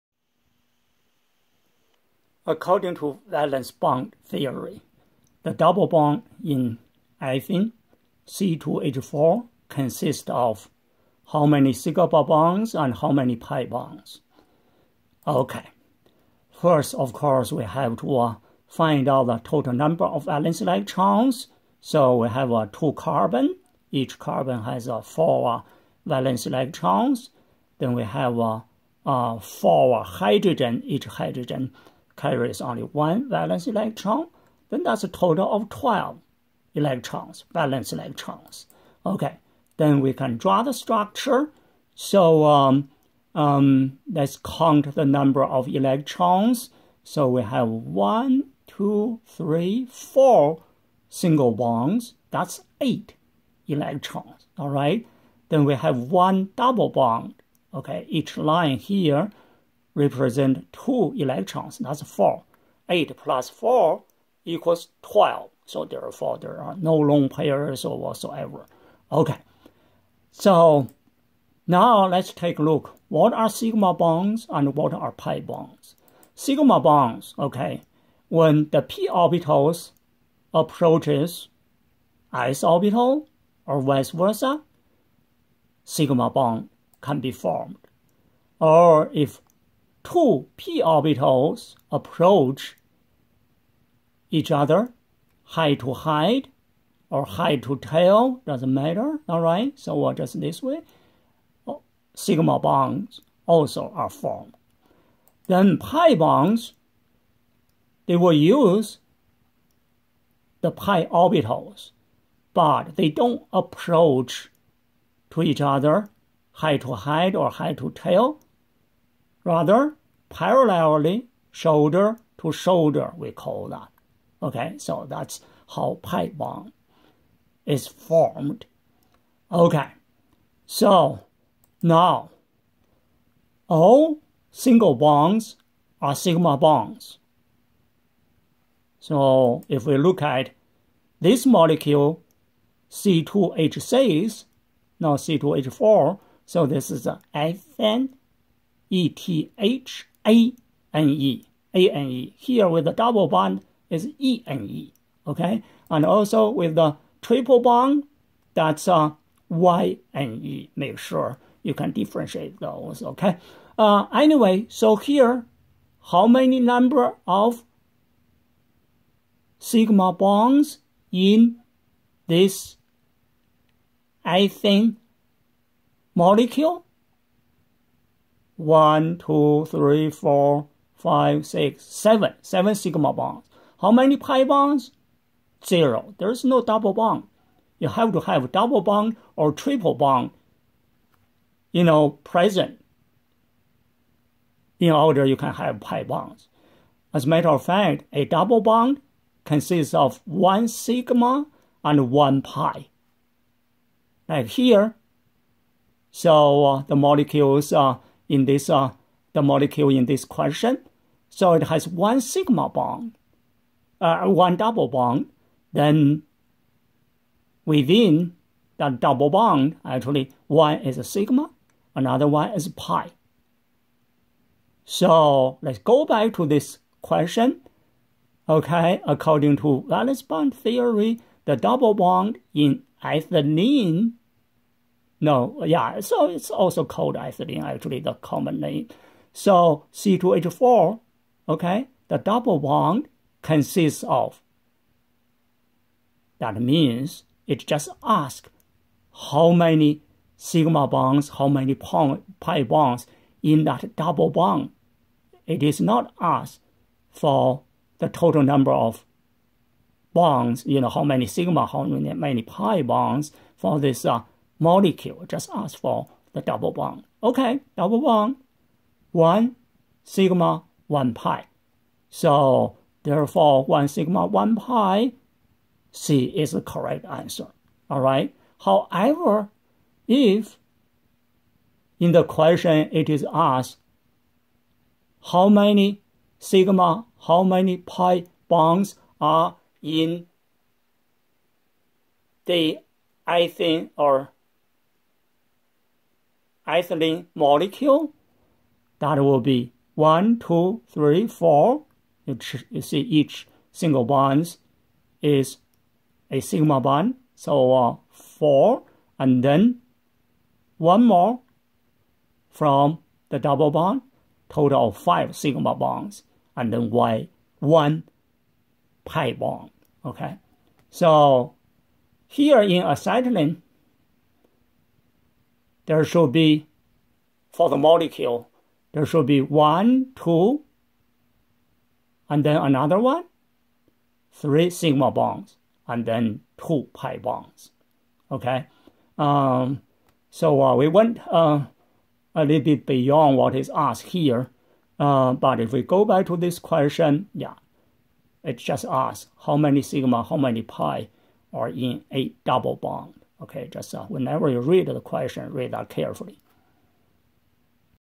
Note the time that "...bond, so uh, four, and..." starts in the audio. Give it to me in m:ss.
5:06.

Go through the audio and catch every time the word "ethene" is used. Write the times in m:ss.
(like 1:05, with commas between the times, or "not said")
0:07, 4:53.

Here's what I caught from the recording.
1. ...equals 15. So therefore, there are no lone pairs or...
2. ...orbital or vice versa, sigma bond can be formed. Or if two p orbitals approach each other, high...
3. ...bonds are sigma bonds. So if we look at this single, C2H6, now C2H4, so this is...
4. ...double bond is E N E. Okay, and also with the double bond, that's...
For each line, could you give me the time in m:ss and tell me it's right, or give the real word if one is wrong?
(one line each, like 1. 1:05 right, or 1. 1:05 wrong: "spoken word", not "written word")
1. 1:04 wrong: "12", not "15"
2. 1:22 right
3. 2:14 wrong: "molecule", not "single"
4. 2:32 wrong: "triple", not "double".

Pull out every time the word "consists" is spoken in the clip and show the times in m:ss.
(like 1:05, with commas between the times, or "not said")
0:09, 3:19, 4:03.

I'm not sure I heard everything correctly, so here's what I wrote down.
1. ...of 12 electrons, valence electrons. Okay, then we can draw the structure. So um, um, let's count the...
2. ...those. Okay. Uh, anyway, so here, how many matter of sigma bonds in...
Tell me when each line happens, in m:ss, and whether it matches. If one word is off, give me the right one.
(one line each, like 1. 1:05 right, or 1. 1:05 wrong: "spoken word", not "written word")
1. 0:35 right
2. 2:42 wrong: "number", not "matter".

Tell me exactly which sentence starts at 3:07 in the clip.
You have to have double bond or triple bond, you know, present in order you can have pi bonds.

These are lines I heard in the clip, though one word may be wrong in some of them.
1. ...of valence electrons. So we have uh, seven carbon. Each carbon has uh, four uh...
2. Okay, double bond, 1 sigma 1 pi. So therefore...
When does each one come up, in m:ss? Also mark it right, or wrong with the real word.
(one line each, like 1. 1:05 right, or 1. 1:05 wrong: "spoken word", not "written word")
1. 0:20 wrong: "two", not "seven"
2. 4:27 right.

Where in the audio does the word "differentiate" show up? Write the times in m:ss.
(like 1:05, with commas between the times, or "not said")
2:41.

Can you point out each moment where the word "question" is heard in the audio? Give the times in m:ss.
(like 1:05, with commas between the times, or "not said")
3:30, 3:47, 4:42, 5:46, 5:55.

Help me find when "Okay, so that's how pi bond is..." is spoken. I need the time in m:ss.
2:04.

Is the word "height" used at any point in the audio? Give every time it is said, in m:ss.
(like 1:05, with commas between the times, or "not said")
1:35, 1:56.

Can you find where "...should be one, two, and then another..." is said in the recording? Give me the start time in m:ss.
5:29.